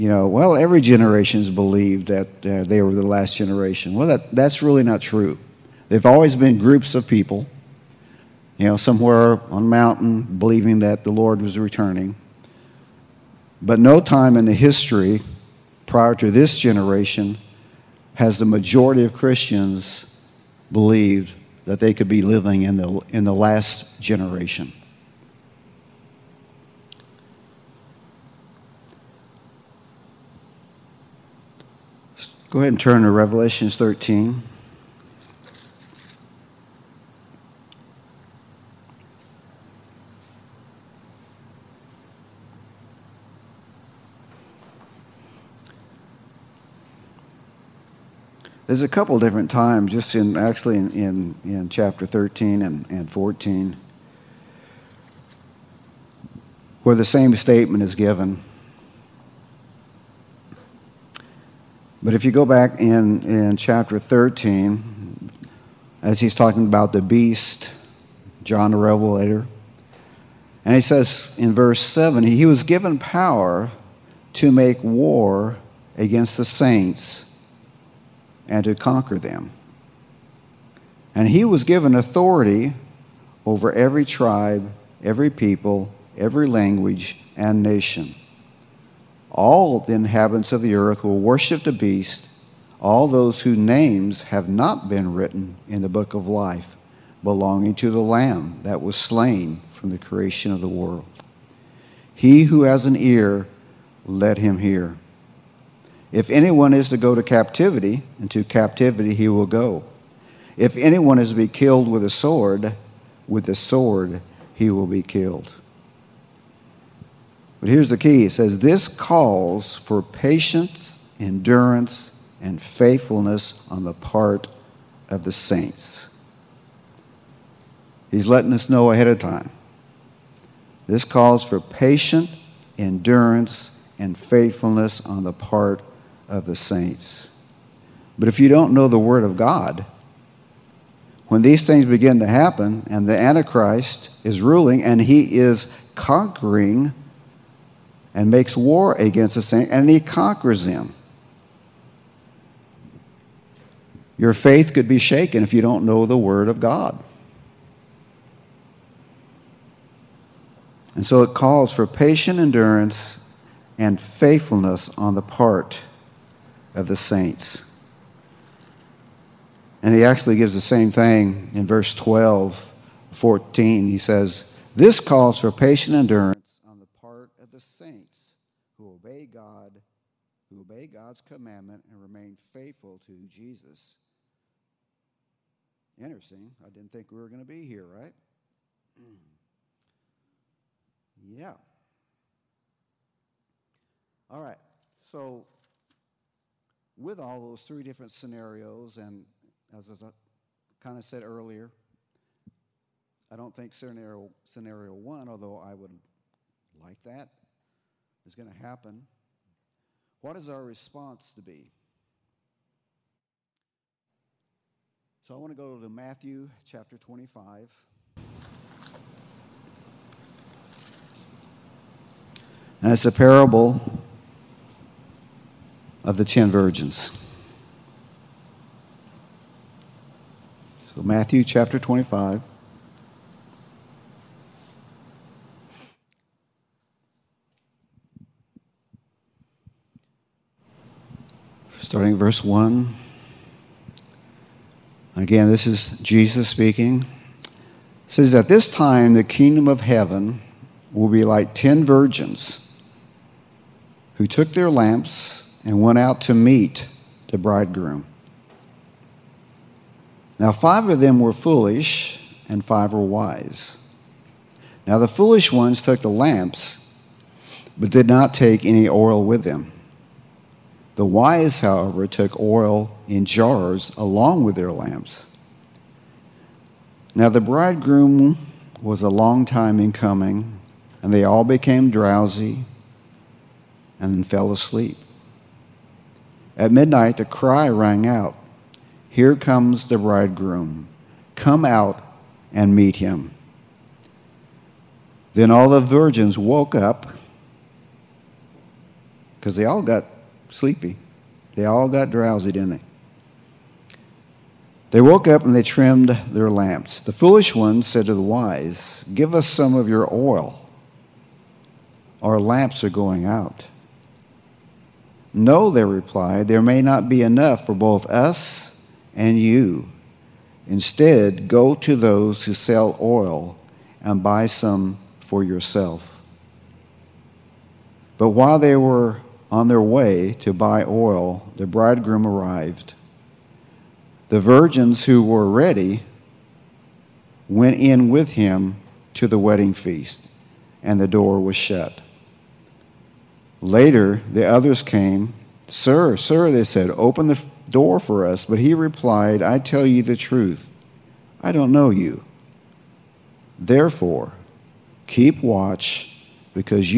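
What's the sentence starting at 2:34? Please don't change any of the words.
Your faith could be shaken if you don't know the Word of God.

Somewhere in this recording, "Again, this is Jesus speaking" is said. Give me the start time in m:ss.
4:05.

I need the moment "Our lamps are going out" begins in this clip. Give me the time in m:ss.
5:12.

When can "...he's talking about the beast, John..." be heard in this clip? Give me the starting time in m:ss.
1:06.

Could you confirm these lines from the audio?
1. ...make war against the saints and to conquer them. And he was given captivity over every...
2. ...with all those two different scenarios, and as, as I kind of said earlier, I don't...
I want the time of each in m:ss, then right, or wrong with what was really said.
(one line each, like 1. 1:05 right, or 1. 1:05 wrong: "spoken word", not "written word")
1. 1:14 wrong: "authority", not "captivity"
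2. 3:17 wrong: "three", not "two".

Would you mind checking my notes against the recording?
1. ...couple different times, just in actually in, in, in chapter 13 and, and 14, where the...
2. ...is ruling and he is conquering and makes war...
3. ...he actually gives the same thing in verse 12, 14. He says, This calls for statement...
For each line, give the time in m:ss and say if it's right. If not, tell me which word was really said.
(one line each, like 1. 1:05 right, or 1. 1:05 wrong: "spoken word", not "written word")
1. 0:48 right
2. 2:24 right
3. 2:49 wrong: "patient", not "statement".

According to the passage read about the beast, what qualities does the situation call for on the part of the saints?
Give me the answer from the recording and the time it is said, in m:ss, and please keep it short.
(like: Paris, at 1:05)
patience, endurance, and faithfulness, at 2:00.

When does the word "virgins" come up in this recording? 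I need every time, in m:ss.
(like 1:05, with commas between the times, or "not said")
3:46, 4:11, 4:55, 5:34.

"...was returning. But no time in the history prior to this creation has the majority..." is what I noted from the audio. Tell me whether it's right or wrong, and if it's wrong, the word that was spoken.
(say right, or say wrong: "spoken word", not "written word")
wrong: "generation", not "creation".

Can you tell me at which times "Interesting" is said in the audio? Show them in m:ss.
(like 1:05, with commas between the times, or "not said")
3:05.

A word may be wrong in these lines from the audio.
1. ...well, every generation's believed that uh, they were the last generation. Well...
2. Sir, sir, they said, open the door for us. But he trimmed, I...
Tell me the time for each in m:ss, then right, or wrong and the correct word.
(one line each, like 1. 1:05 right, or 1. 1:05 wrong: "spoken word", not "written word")
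1. 0:00 right
2. 5:45 wrong: "replied", not "trimmed".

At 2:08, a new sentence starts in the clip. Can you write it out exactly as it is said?
He's letting us know ahead of time.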